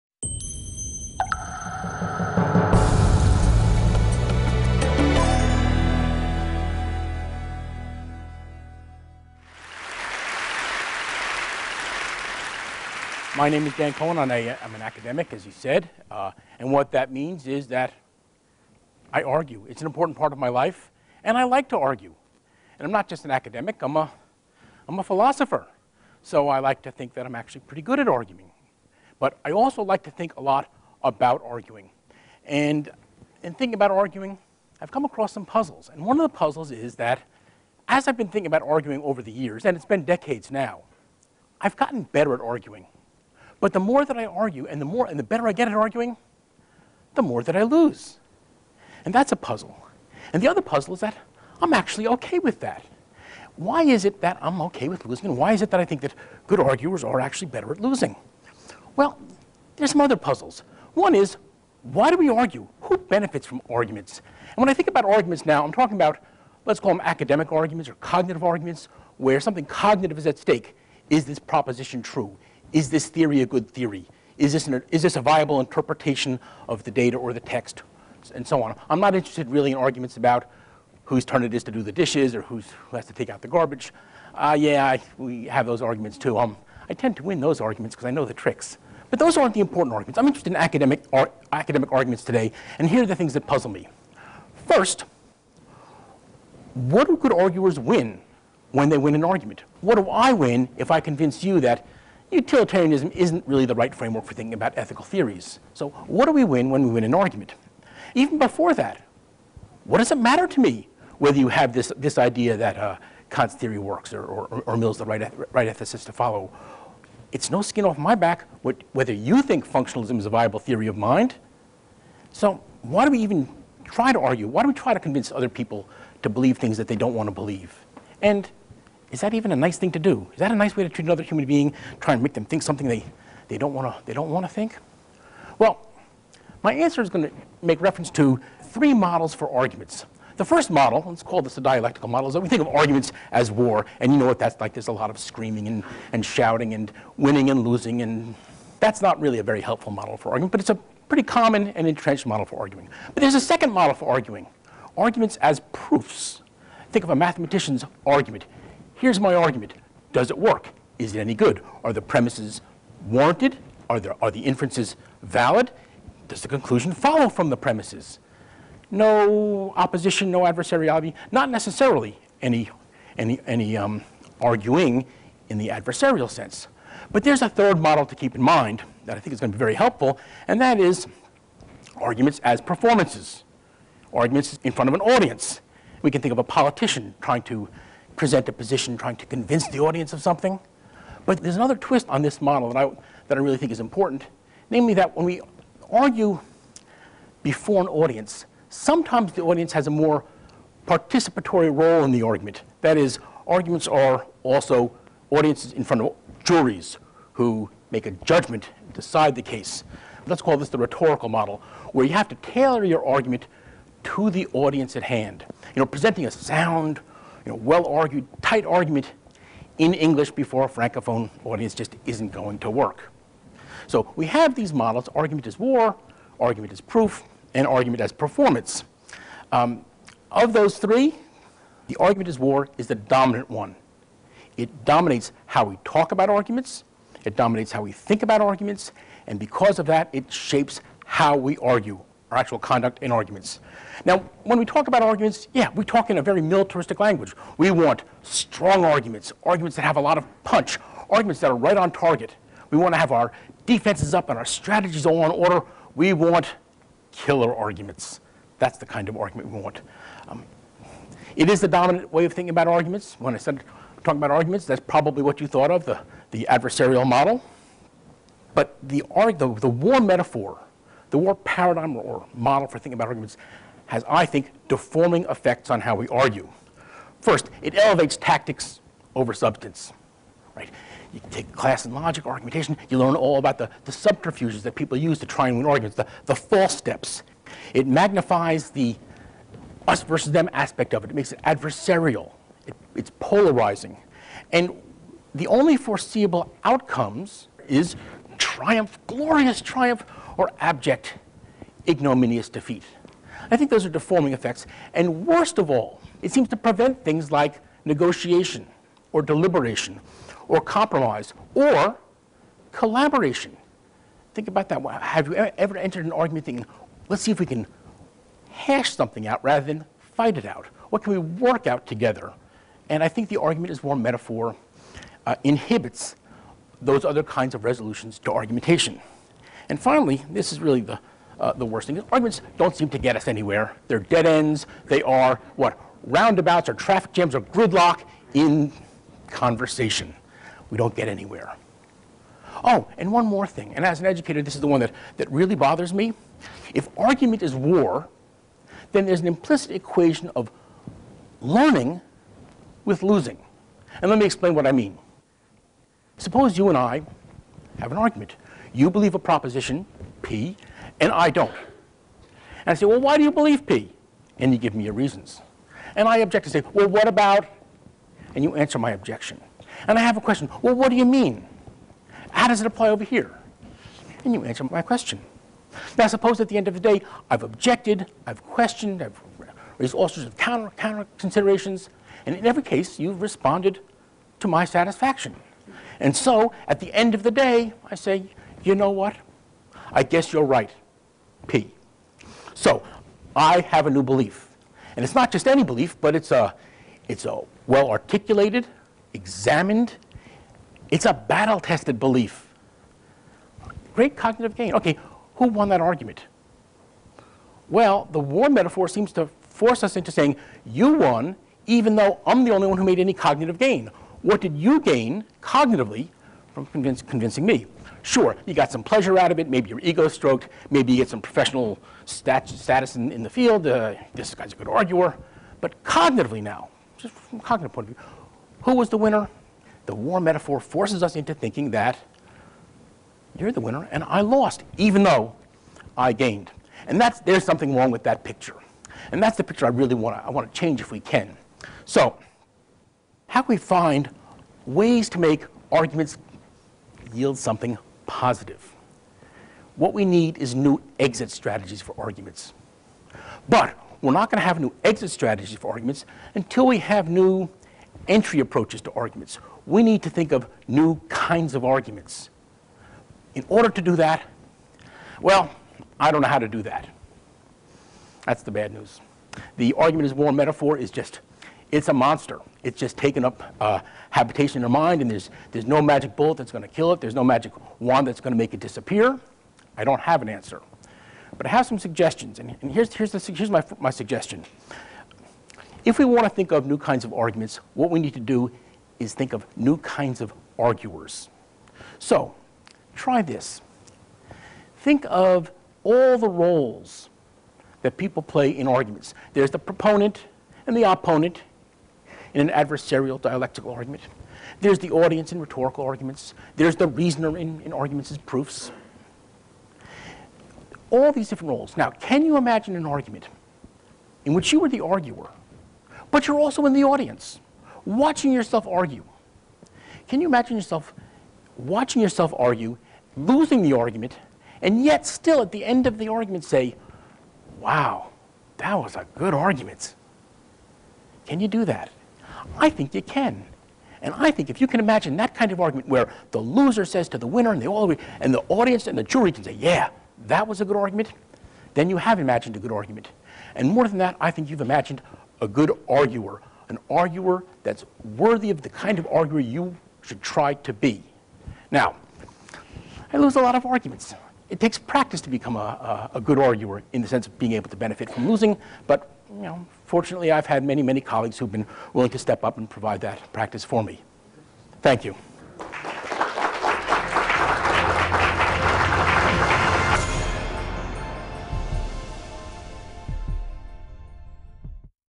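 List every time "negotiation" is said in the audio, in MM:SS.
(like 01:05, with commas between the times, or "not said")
05:07.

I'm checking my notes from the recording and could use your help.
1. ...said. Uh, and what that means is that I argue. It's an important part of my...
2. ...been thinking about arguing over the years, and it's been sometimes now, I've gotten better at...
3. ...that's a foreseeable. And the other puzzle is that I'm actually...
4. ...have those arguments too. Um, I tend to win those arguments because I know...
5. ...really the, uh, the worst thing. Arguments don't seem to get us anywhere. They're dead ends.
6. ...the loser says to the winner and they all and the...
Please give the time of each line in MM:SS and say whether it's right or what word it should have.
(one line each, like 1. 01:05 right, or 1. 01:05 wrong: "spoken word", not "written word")
1. 00:15 right
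2. 00:38 wrong: "decades", not "sometimes"
3. 00:49 wrong: "puzzle", not "foreseeable"
4. 01:25 right
5. 05:30 right
6. 08:56 right.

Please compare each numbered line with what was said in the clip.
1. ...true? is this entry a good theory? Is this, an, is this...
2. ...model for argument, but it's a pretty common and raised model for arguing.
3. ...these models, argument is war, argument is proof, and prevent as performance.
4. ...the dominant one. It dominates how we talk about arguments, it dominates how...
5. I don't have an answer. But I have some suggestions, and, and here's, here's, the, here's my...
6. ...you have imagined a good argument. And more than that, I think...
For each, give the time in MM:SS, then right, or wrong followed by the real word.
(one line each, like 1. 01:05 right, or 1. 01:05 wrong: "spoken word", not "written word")
1. 01:12 wrong: "theory", not "entry"
2. 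02:29 wrong: "entrenched", not "raised"
3. 03:44 wrong: "argument", not "prevent"
4. 03:52 right
5. 07:59 right
6. 09:01 right.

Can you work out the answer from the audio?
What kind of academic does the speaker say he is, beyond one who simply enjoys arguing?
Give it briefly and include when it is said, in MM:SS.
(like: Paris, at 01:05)
philosopher, at 00:24.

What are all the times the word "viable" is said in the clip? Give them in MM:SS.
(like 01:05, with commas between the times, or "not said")
01:15, 02:00.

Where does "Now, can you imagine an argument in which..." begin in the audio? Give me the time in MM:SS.
08:31.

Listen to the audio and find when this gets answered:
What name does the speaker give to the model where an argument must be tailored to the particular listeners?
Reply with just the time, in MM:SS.
03:30.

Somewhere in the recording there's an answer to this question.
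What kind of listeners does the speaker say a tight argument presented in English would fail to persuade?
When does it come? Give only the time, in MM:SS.
03:40.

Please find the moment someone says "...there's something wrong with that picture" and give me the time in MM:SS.
07:17.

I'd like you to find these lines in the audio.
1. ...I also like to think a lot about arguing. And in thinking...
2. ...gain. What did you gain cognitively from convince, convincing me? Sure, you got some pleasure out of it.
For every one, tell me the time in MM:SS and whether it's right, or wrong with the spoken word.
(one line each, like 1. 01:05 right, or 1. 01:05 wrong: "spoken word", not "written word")
1. 00:29 right
2. 06:53 right.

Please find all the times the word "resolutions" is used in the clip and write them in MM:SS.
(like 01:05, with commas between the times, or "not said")
05:27.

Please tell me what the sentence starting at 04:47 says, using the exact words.
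It magnifies the us versus them aspect of it.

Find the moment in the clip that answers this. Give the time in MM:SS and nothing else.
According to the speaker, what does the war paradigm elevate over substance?
04:38.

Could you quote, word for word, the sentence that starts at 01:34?
First, what do good arguers win when they win an argument?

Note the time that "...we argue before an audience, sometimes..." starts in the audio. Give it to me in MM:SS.
03:15.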